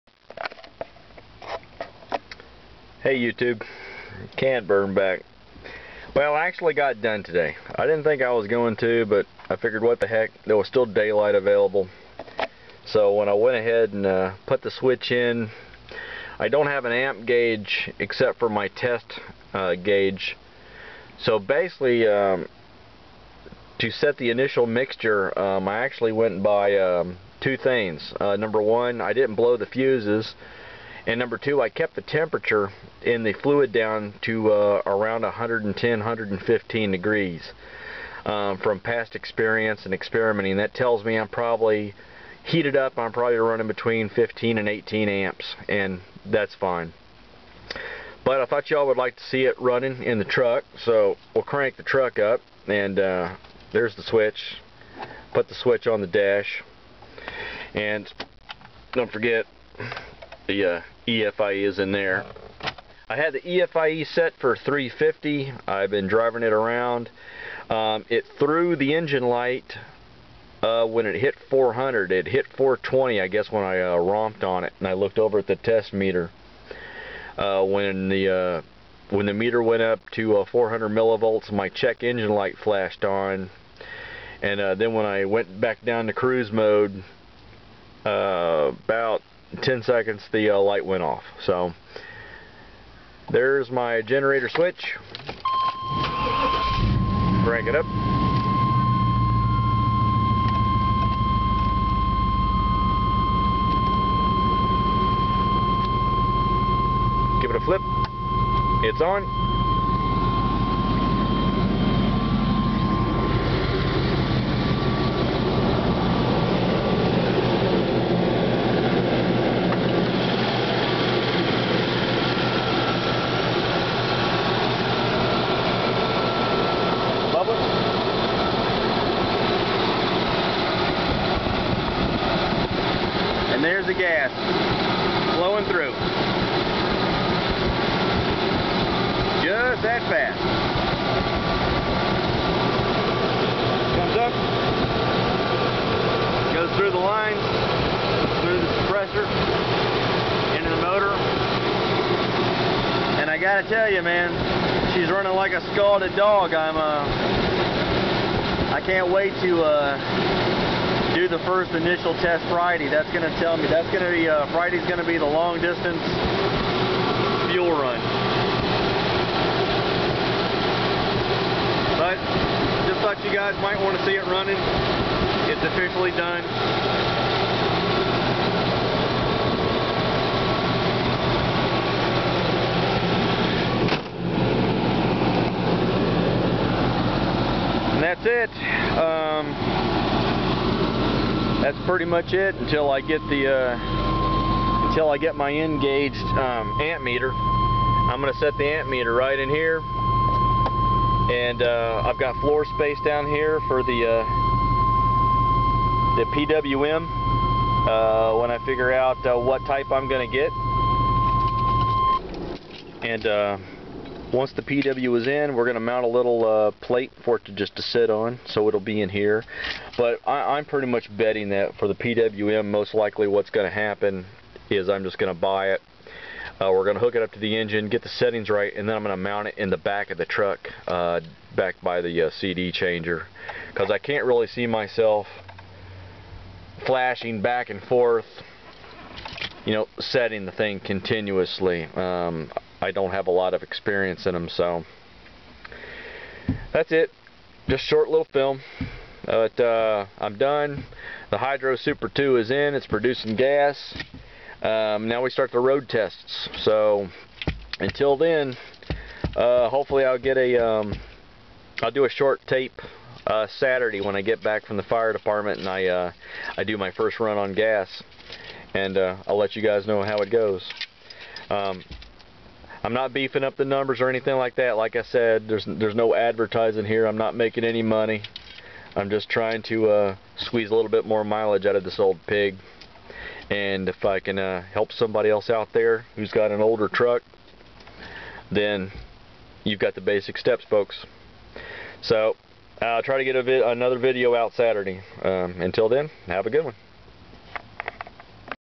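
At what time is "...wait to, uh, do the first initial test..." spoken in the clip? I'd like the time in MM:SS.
02:39.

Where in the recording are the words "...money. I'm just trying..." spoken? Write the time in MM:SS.
04:37.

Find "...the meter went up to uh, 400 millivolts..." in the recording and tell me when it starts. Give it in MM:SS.
01:19.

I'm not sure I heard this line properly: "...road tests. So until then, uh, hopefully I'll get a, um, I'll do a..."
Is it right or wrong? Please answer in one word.
right.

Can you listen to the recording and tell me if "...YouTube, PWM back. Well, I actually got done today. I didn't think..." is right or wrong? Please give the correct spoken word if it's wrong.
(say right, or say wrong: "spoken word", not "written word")
wrong: "Cantburn", not "PWM".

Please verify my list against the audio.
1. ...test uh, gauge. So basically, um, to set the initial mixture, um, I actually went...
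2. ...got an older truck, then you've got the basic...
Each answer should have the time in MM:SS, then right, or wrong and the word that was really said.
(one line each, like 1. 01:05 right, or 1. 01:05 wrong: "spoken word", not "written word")
1. 00:18 right
2. 04:46 right.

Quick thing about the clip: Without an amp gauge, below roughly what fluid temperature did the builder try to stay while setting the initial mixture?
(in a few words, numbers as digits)
110 to 115 degrees.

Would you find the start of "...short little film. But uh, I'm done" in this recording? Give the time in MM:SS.
04:07.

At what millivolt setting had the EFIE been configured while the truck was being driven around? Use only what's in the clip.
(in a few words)
350.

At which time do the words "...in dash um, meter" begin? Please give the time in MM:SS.
03:15.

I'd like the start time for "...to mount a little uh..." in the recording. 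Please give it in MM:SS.
03:35.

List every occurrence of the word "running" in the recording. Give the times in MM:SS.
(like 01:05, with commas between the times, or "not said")
00:43, 00:49, 02:35, 02:54.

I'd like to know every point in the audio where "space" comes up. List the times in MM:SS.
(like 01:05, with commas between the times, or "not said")
03:22.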